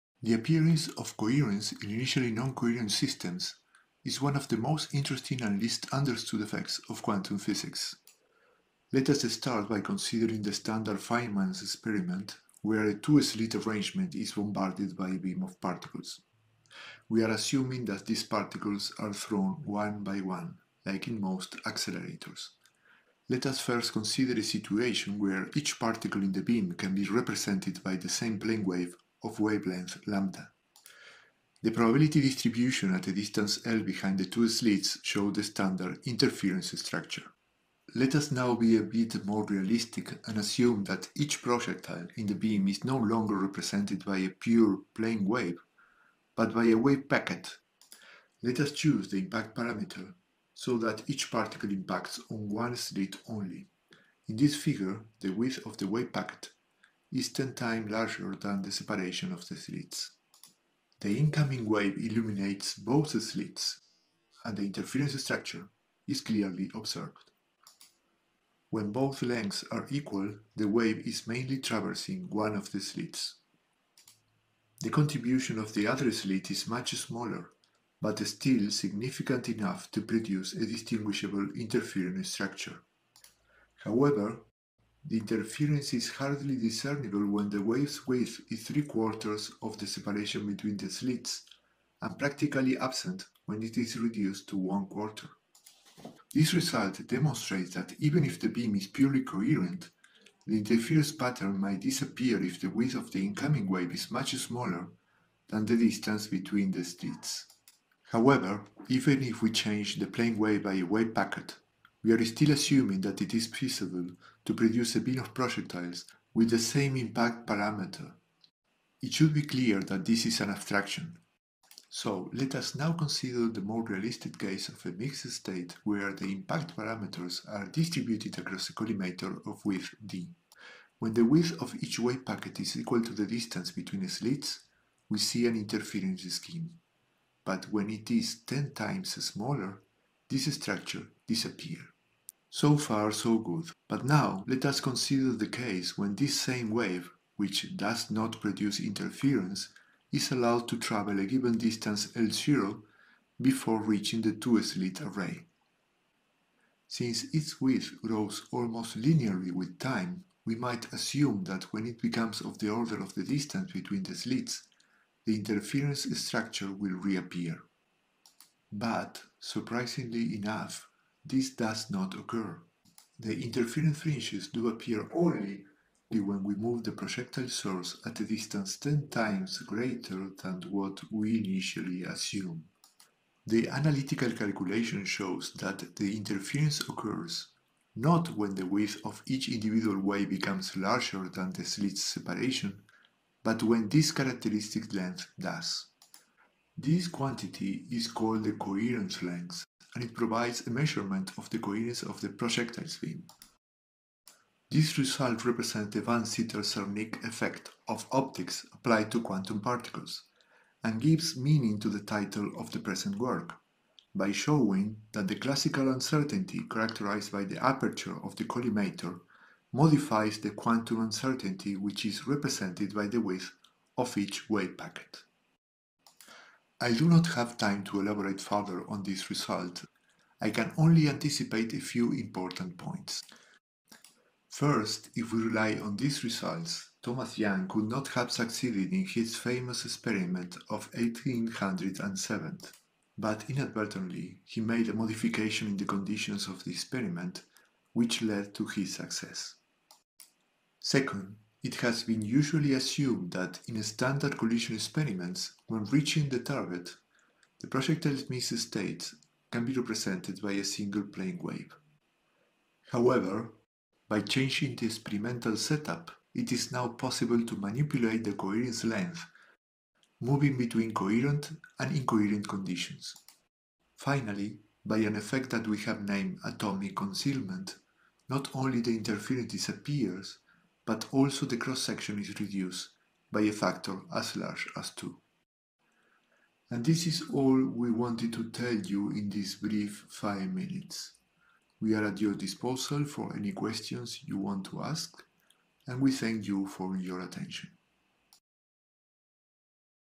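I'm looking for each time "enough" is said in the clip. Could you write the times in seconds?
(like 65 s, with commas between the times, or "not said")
79 s, 170 s.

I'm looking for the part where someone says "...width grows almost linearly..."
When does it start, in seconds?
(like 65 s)
157 s.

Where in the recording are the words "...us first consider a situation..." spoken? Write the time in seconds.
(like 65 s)
23 s.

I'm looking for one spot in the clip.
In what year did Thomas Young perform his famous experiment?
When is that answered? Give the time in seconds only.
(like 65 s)
240 s.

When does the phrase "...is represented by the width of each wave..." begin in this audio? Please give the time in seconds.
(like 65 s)
222 s.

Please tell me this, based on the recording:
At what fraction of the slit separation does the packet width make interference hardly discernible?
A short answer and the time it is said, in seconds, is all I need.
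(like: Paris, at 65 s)
three-quarters, at 88 s.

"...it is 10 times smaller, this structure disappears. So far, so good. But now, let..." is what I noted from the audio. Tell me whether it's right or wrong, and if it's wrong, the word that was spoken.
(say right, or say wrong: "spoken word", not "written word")
right.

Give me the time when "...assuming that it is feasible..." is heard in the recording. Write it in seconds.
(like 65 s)
112 s.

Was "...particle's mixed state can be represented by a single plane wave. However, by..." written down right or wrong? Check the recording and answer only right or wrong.
wrong.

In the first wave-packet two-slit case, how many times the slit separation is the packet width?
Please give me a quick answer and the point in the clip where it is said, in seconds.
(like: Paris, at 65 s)
10 times, at 57 s.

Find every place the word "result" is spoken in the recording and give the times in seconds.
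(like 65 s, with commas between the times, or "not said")
96 s, 204 s, 229 s, 236 s.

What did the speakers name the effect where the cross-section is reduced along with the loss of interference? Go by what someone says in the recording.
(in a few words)
atomic concealment.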